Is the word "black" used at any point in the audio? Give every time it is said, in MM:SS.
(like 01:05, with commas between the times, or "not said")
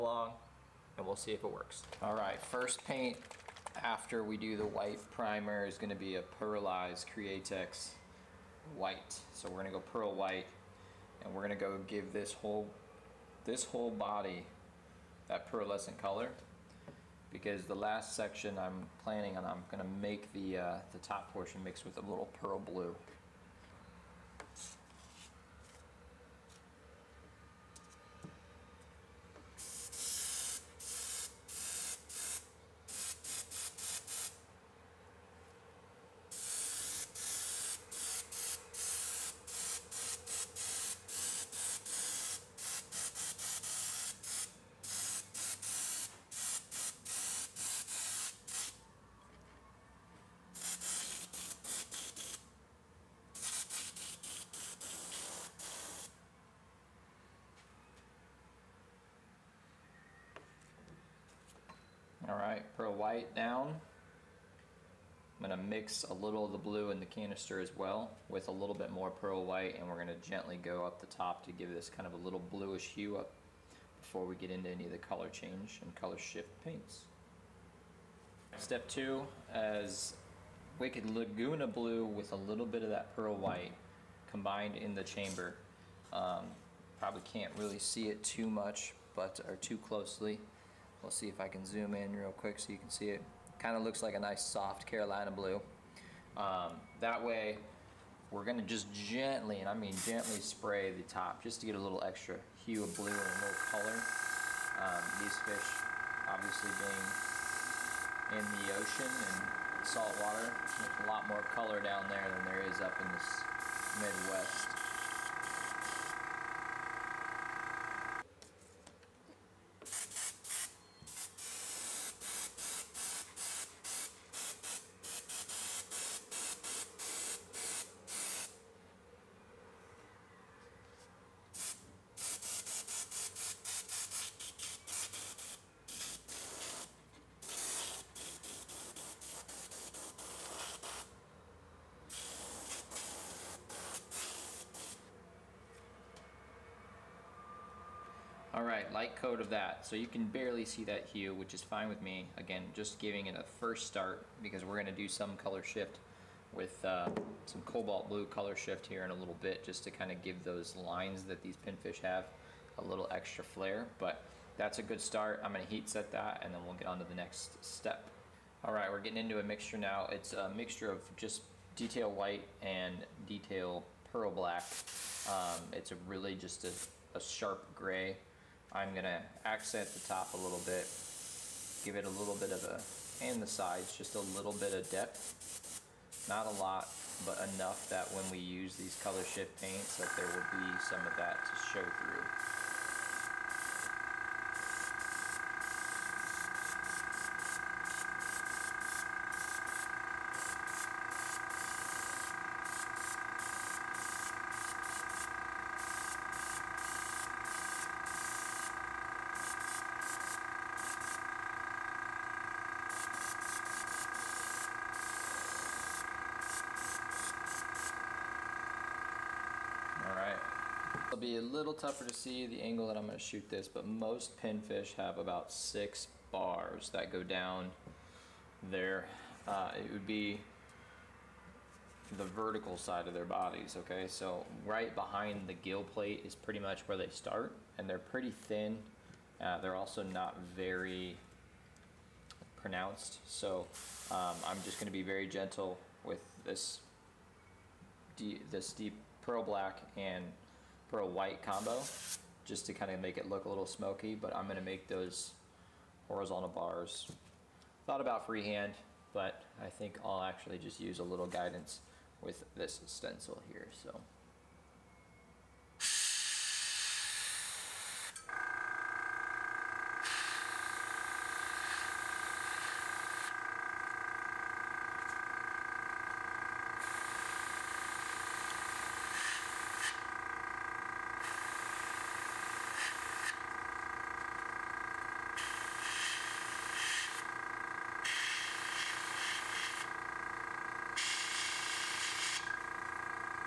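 02:54, 04:09.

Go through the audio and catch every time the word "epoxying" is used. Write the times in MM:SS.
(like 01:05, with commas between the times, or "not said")
not said.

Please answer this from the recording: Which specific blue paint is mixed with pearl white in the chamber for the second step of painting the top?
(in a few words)
Wicked Laguna Blue.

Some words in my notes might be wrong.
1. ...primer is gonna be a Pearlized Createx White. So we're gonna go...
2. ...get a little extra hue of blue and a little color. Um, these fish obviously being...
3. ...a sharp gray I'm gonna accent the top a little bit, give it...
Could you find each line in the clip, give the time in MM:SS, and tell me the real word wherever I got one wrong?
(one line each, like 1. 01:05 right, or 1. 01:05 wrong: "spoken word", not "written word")
1. 00:04 right
2. 01:41 right
3. 02:57 right.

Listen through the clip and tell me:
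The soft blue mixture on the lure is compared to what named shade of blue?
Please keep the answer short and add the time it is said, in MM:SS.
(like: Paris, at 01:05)
Carolina blue, at 01:34.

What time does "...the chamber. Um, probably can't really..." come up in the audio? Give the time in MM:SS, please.
01:24.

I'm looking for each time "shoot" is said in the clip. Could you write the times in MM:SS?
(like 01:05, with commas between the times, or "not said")
03:43.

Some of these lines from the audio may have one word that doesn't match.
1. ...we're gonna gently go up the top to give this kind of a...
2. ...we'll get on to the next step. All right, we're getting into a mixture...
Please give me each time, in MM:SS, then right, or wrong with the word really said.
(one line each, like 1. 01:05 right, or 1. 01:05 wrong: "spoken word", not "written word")
1. 01:09 right
2. 02:46 right.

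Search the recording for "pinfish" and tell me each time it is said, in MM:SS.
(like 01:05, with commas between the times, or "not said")
02:41, 03:44.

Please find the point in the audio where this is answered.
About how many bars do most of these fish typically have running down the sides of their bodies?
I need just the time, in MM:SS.
03:45.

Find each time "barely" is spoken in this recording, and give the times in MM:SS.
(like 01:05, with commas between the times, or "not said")
02:30.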